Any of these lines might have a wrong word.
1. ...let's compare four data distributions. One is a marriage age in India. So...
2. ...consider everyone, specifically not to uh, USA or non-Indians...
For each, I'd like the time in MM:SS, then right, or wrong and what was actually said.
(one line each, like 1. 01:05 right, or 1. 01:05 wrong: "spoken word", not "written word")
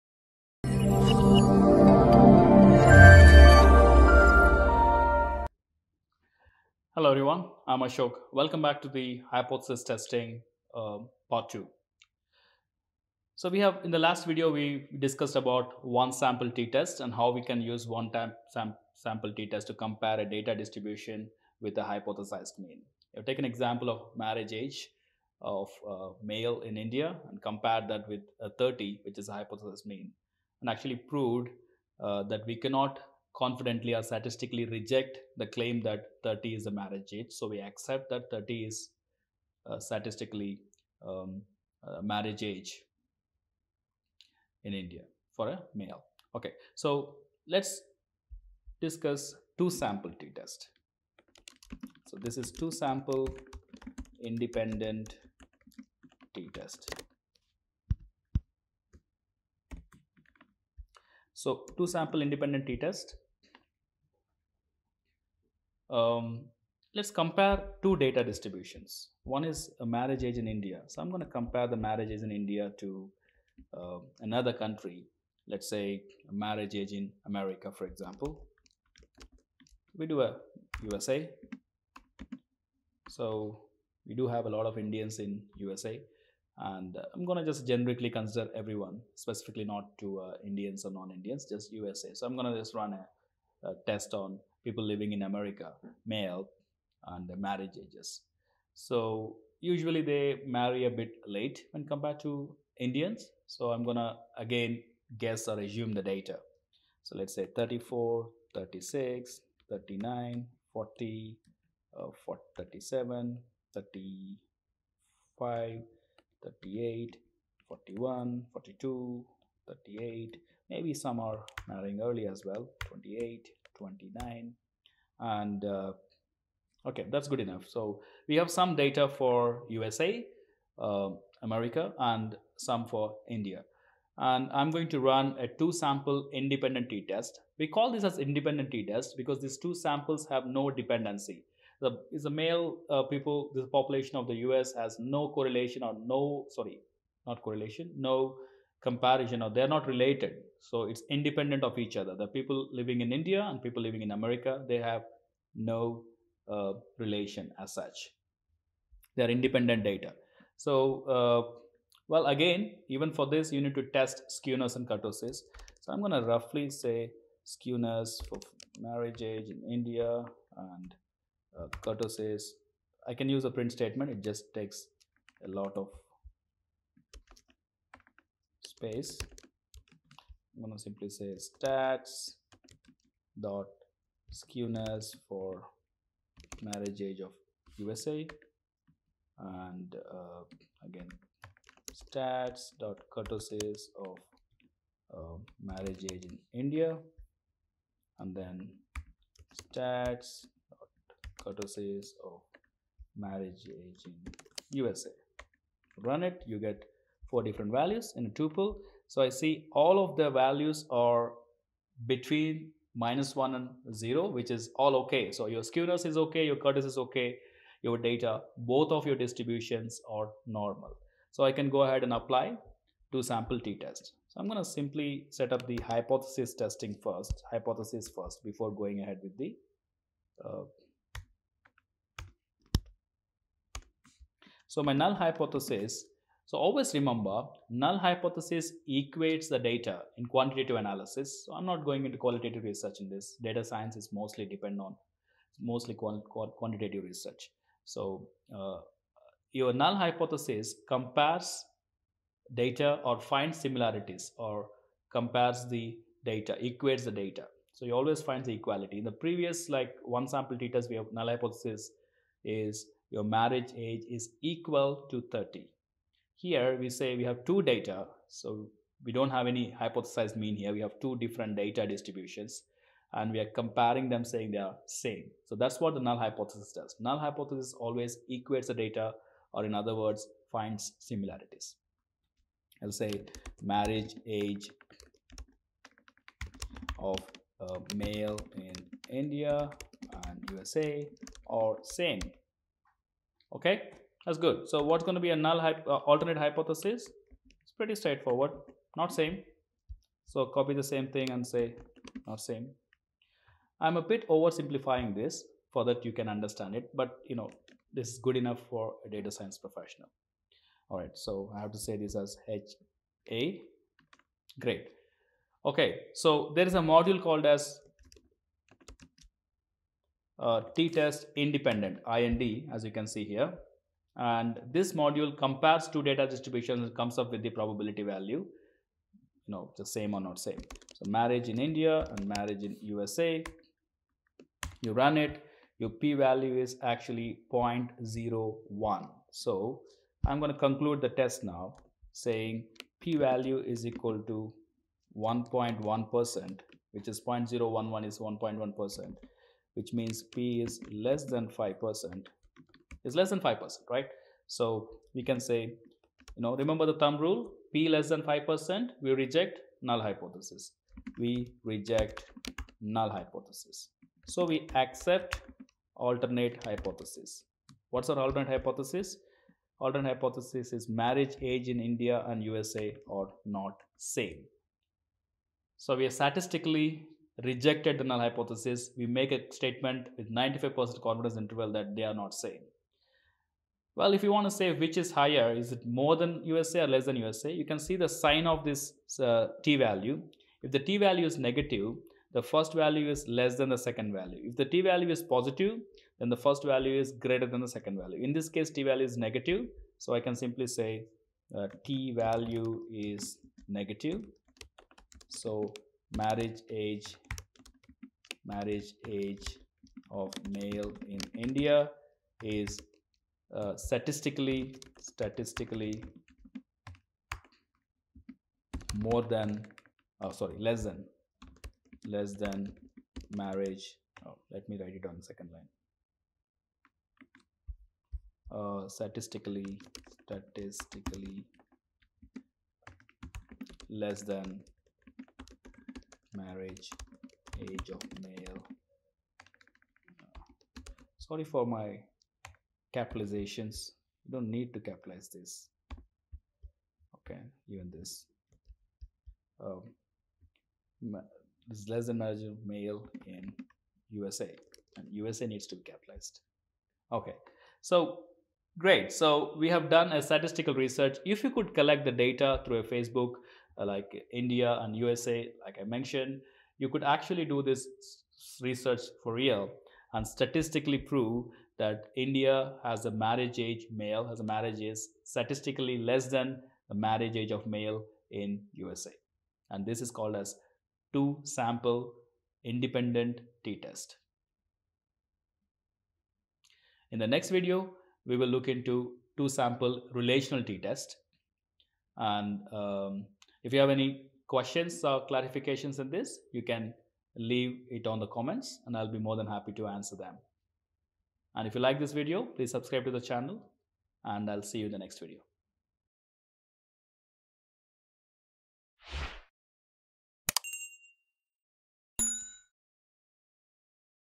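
1. 01:06 wrong: "two", not "four"
2. 01:28 wrong: "Indians", not "USA".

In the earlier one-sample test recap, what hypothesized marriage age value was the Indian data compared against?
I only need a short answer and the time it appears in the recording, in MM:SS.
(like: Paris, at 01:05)
30, at 00:28.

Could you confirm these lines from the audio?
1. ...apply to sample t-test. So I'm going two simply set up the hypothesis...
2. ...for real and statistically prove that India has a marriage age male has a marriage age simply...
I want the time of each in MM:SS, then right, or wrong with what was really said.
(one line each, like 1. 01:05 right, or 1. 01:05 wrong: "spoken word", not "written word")
1. 03:42 right
2. 07:49 wrong: "statistically", not "simply".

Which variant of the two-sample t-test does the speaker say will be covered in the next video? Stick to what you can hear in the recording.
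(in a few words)
Two sample relational t-test.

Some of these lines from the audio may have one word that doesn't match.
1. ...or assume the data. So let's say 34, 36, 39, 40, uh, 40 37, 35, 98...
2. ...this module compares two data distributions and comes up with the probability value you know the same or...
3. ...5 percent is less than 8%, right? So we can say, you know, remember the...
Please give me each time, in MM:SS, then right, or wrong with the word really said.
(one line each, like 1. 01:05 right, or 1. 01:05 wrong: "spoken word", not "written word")
1. 01:45 wrong: "38", not "98"
2. 05:24 right
3. 05:51 wrong: "5", not "8".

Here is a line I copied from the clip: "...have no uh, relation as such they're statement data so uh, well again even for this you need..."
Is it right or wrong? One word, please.
wrong.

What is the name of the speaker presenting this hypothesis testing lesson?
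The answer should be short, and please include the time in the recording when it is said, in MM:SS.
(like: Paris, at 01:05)
Ashok, at 00:07.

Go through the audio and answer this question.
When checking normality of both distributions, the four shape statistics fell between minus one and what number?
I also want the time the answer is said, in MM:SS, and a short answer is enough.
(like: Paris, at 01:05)
0, at 03:33.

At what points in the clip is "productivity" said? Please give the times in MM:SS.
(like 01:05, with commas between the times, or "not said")
not said.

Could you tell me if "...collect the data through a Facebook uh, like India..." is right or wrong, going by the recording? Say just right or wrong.
right.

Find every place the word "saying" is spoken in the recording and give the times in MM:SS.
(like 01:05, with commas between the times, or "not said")
04:34, 05:42.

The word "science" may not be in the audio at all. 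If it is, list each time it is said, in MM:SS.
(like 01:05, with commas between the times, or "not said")
04:03, 05:09.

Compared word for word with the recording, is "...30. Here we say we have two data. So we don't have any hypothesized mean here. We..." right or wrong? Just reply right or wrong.
right.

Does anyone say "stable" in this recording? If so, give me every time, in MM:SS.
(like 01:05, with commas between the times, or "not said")
not said.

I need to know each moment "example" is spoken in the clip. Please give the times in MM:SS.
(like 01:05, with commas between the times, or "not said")
00:23, 01:17.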